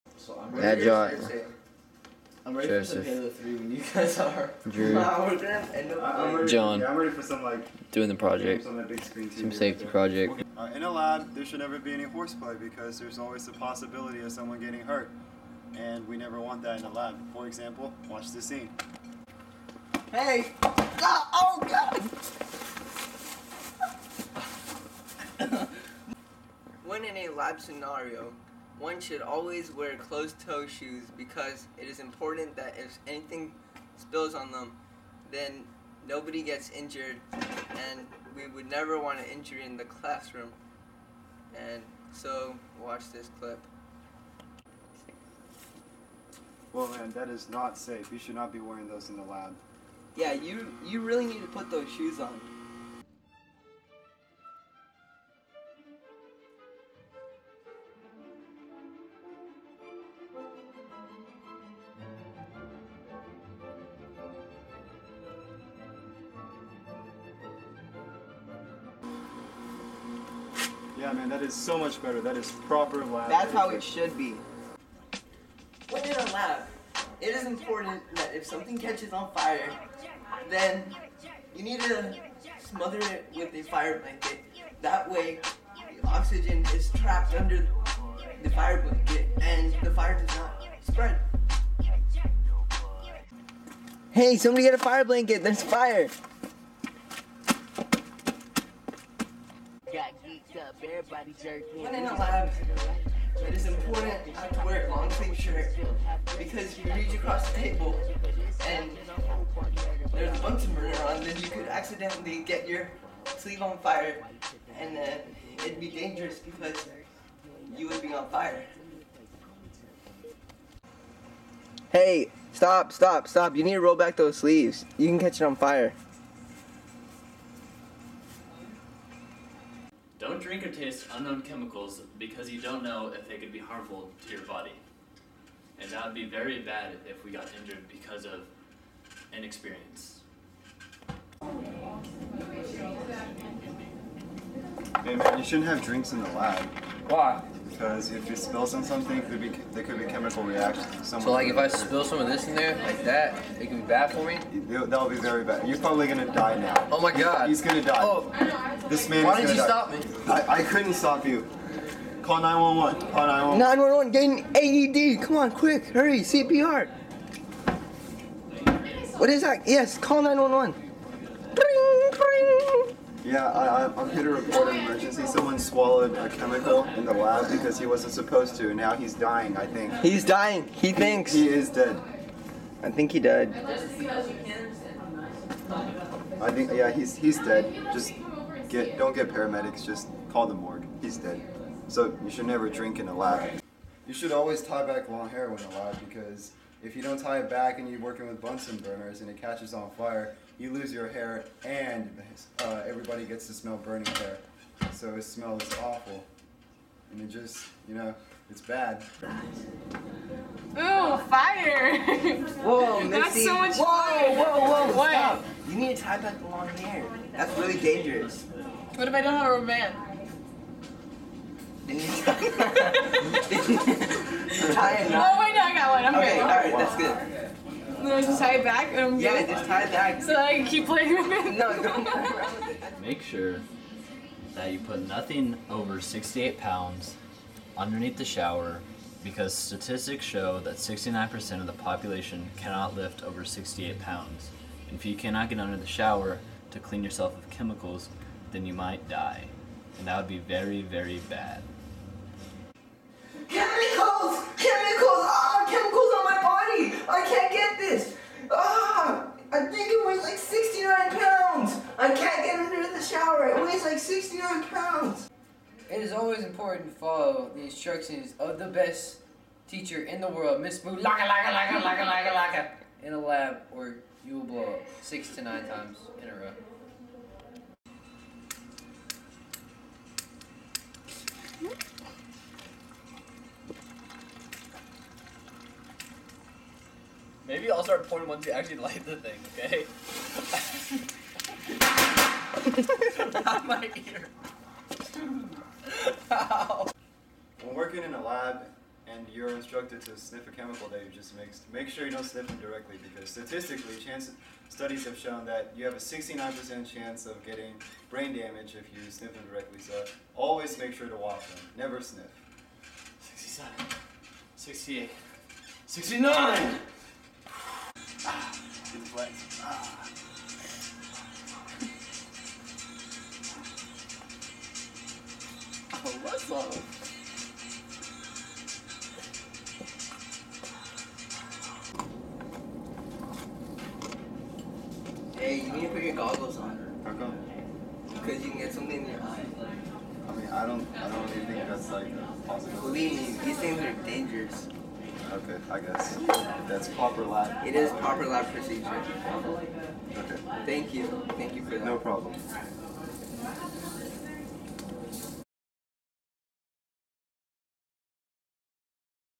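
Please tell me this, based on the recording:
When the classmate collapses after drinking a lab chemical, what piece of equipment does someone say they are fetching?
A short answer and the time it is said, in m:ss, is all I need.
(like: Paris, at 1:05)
AED, at 2:45.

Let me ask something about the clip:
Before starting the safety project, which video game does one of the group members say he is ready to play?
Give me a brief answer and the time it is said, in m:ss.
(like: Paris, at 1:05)
Halo 3, at 0:03.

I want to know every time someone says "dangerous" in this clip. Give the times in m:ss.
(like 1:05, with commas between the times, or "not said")
1:55, 3:37, 5:44.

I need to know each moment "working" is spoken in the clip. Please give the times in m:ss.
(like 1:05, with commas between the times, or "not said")
3:17, 4:57.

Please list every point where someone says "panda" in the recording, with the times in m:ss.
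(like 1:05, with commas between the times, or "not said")
not said.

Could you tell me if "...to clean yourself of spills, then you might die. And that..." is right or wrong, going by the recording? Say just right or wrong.
wrong.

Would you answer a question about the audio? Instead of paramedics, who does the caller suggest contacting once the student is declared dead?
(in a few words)
The morgue.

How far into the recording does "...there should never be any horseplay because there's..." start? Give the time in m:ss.
0:11.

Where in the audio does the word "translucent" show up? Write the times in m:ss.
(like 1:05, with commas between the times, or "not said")
not said.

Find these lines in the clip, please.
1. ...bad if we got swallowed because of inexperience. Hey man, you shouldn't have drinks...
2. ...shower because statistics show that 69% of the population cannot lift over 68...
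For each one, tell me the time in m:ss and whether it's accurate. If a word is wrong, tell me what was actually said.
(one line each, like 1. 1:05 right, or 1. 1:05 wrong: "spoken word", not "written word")
1. 2:16 wrong: "injured", not "swallowed"
2. 3:58 right.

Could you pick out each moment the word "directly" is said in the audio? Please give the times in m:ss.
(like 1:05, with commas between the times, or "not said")
5:02, 5:09.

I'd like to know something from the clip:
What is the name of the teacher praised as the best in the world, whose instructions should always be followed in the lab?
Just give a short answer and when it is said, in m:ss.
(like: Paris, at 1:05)
Miss Moo, at 4:30.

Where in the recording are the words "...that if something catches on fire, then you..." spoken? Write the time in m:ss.
1:18.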